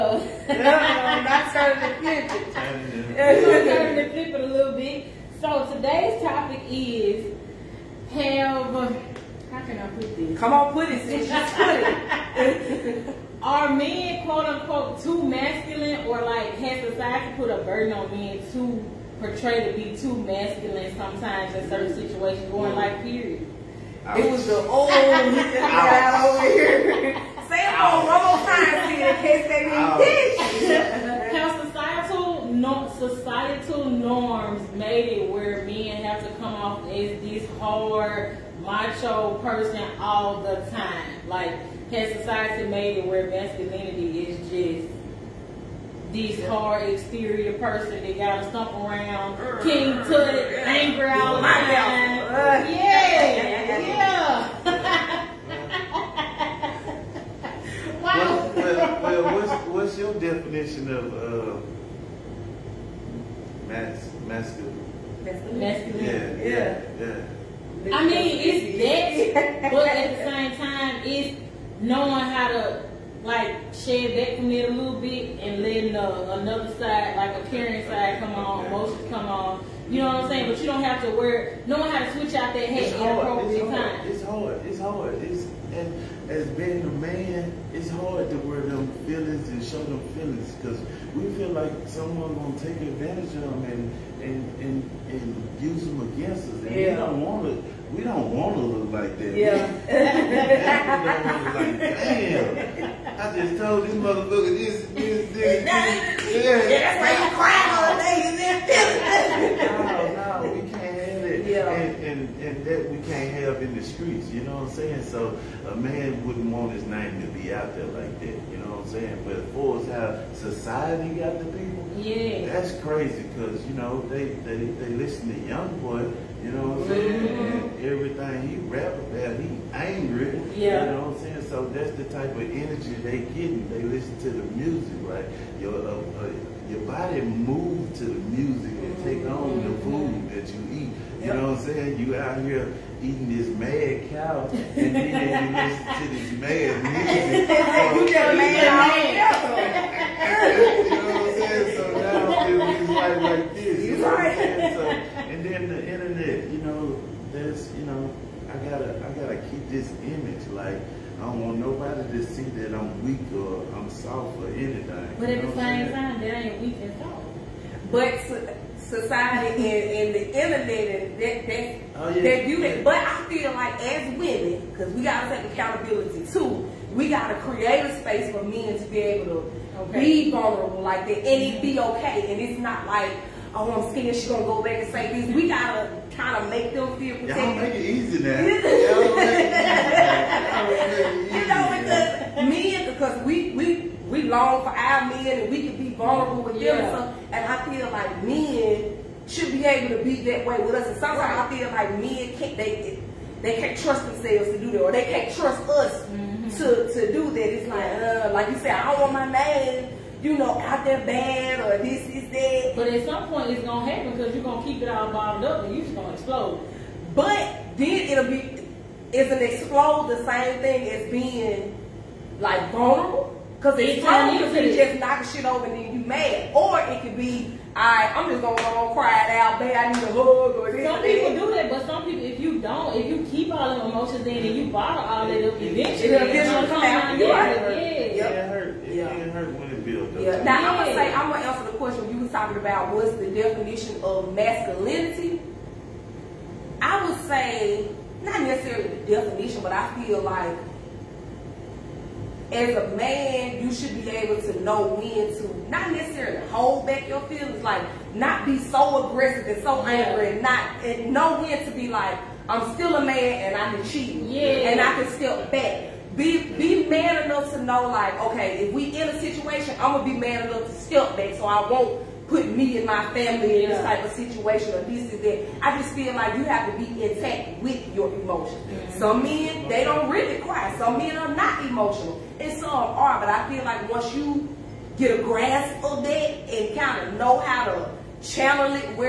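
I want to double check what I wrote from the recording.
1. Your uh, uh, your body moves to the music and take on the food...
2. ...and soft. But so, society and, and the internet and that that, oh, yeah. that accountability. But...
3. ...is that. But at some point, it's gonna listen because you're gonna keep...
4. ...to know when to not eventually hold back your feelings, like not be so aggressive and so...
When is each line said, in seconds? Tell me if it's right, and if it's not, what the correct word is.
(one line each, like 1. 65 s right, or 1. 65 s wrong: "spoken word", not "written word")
1. 135 s right
2. 166 s wrong: "beauty", not "accountability"
3. 212 s wrong: "happen", not "listen"
4. 254 s wrong: "necessarily", not "eventually".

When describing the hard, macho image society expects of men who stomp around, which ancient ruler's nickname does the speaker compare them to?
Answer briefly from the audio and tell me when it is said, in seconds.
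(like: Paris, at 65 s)
King Tut, at 49 s.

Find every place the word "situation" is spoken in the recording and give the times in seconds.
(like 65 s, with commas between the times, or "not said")
21 s, 269 s, 274 s.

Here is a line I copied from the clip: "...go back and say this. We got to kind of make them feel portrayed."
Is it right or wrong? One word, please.
wrong.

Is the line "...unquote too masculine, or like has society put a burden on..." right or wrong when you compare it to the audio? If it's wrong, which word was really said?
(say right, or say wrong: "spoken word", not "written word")
right.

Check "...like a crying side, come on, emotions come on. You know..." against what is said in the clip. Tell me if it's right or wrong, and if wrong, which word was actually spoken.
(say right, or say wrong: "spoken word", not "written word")
wrong: "caring", not "crying".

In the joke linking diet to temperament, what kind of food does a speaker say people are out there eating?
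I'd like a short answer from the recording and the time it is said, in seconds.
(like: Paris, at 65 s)
Mad cow, at 143 s.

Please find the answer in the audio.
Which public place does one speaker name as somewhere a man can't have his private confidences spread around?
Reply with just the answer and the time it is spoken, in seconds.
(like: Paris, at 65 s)
The streets, at 113 s.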